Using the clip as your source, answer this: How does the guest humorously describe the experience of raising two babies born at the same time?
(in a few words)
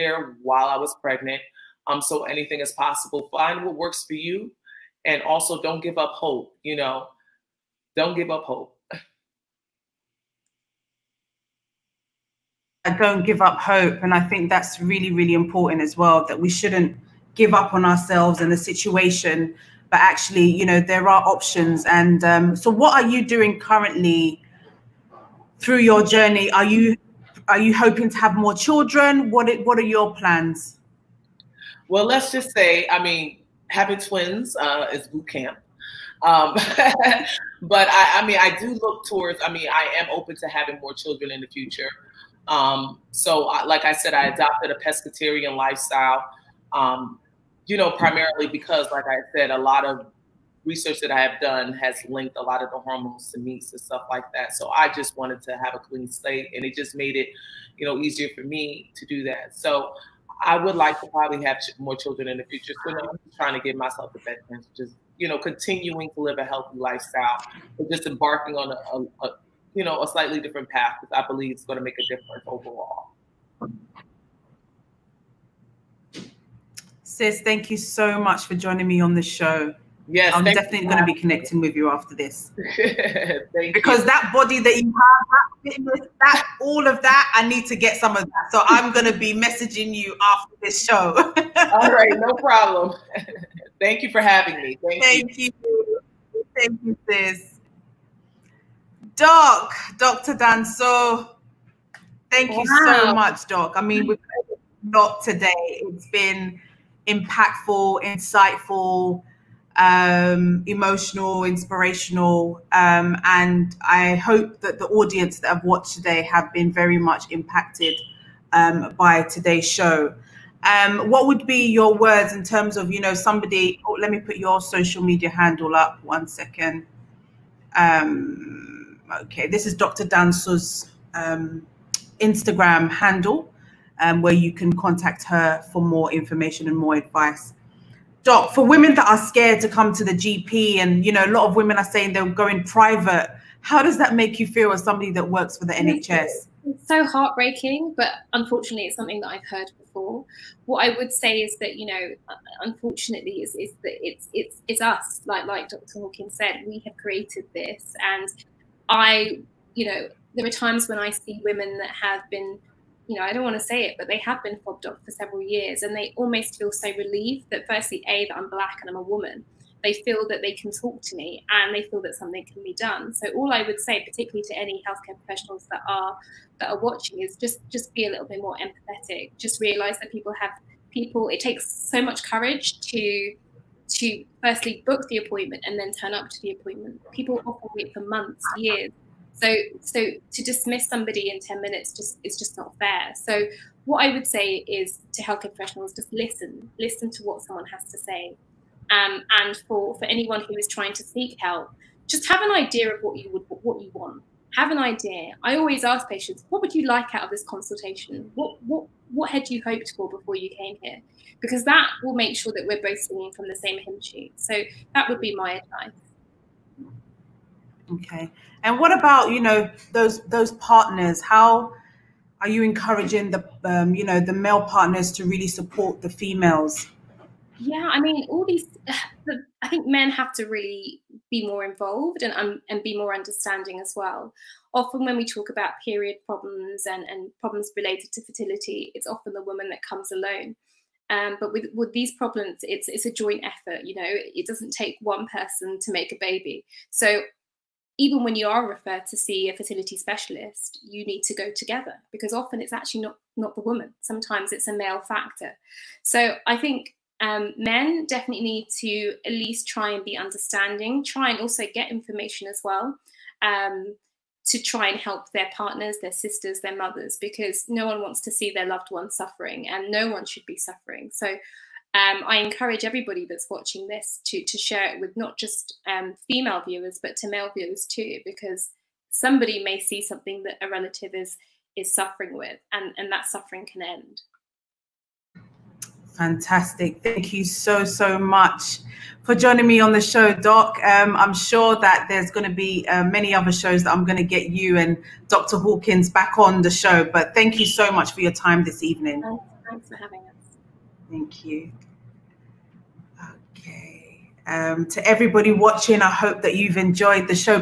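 Boot camp.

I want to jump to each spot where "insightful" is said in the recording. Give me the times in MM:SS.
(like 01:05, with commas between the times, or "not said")
01:48.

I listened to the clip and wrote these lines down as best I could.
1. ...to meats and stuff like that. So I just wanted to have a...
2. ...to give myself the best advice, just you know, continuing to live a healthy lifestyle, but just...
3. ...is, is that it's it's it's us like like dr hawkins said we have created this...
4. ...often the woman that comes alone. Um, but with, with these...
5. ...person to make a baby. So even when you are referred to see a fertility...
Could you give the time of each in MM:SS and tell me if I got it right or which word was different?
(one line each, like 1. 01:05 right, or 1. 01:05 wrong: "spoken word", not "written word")
1. 00:53 right
2. 01:03 wrong: "chance", not "advice"
3. 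02:33 right
4. 03:59 right
5. 04:05 right.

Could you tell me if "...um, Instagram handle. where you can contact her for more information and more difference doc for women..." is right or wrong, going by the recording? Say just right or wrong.
wrong.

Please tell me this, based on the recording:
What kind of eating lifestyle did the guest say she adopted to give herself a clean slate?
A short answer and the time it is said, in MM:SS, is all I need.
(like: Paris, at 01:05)
Pescatarian, at 00:44.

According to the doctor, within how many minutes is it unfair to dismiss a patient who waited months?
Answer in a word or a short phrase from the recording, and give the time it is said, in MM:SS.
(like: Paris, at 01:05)
10, at 03:11.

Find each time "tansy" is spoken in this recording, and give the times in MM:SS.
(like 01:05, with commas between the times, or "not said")
not said.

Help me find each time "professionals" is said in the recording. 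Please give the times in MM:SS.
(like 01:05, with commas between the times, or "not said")
02:55, 03:15.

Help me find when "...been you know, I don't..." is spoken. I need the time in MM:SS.
02:42.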